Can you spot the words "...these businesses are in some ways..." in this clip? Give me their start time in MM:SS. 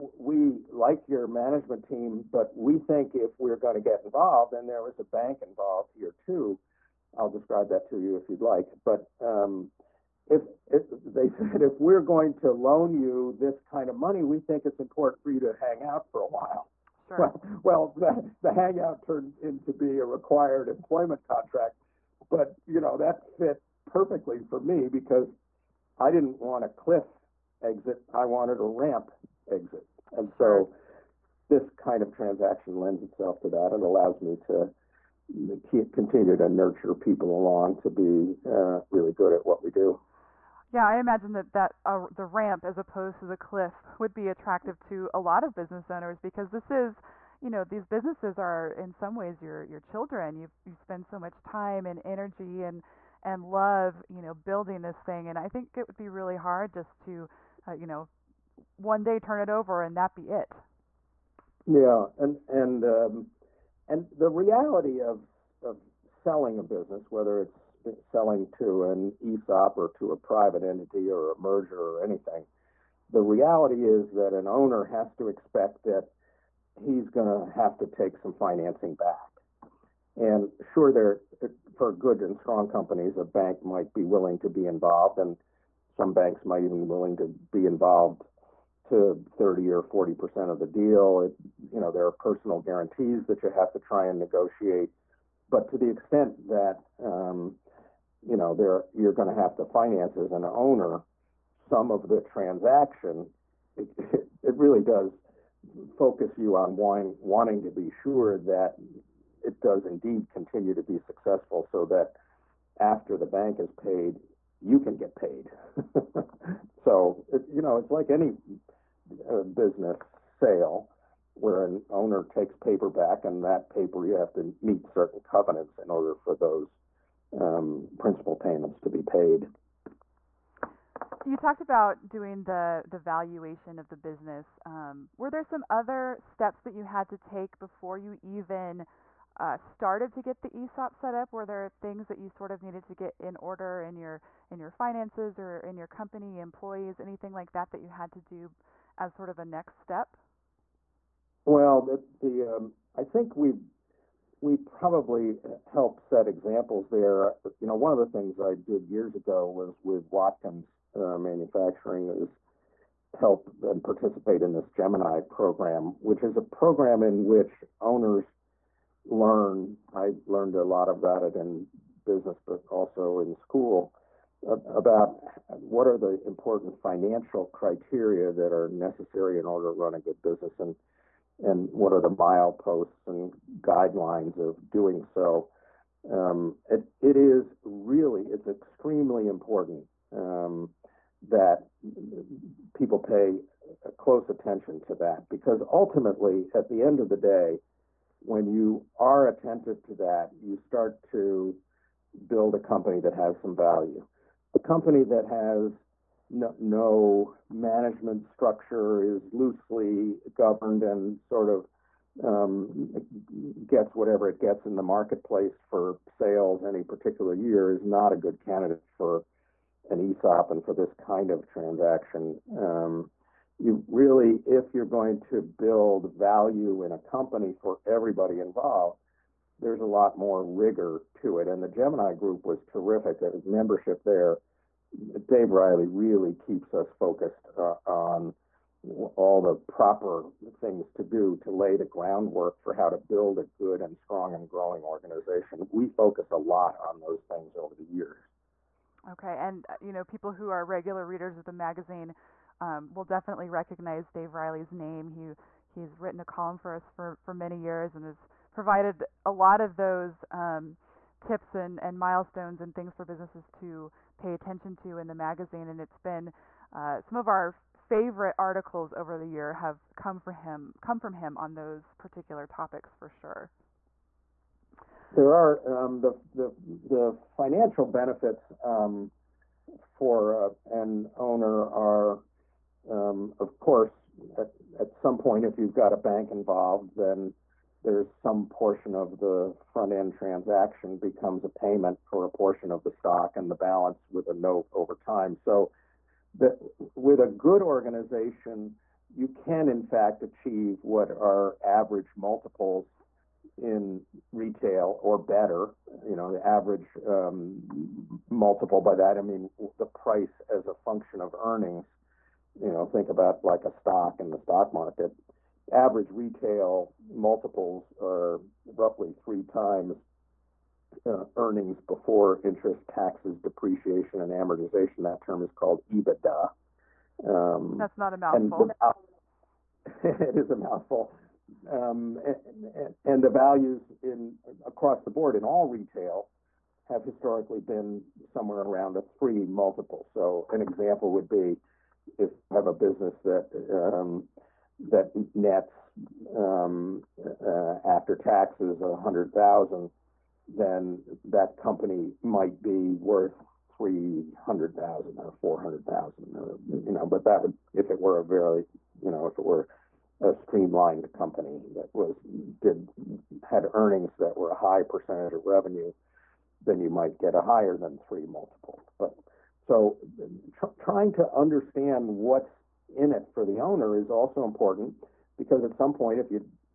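00:47.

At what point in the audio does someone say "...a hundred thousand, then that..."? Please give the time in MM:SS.
05:48.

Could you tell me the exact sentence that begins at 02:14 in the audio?
Um, were there some other steps that you had to take before you even uh, started to get the ESOP set up?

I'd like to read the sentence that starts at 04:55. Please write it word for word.
So, that with a good organization, you can in fact achieve what are average multiples in retail or better.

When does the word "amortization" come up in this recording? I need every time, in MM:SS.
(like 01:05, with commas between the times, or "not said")
05:24.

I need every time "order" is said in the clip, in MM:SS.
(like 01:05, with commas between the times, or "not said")
02:05, 02:23, 02:59.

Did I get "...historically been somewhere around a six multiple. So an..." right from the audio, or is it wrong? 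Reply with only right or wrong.
wrong.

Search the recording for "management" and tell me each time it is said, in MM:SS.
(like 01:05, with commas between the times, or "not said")
00:01, 03:27.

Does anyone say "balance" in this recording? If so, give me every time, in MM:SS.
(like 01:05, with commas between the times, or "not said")
04:53.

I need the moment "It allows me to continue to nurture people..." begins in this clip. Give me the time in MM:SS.
00:33.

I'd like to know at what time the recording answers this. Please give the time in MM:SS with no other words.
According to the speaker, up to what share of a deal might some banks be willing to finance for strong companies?
01:29.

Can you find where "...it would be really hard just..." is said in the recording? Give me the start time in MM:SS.
00:55.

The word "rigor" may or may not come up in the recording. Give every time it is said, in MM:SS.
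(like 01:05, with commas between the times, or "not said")
03:50.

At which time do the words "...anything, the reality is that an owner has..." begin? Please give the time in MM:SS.
01:12.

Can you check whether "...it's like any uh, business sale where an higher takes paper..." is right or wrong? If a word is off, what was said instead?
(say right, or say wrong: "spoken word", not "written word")
wrong: "owner", not "higher".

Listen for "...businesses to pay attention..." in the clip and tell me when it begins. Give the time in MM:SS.
04:23.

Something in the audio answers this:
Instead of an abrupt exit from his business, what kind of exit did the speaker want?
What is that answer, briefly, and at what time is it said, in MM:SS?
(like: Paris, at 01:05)
A ramp exit, at 00:28.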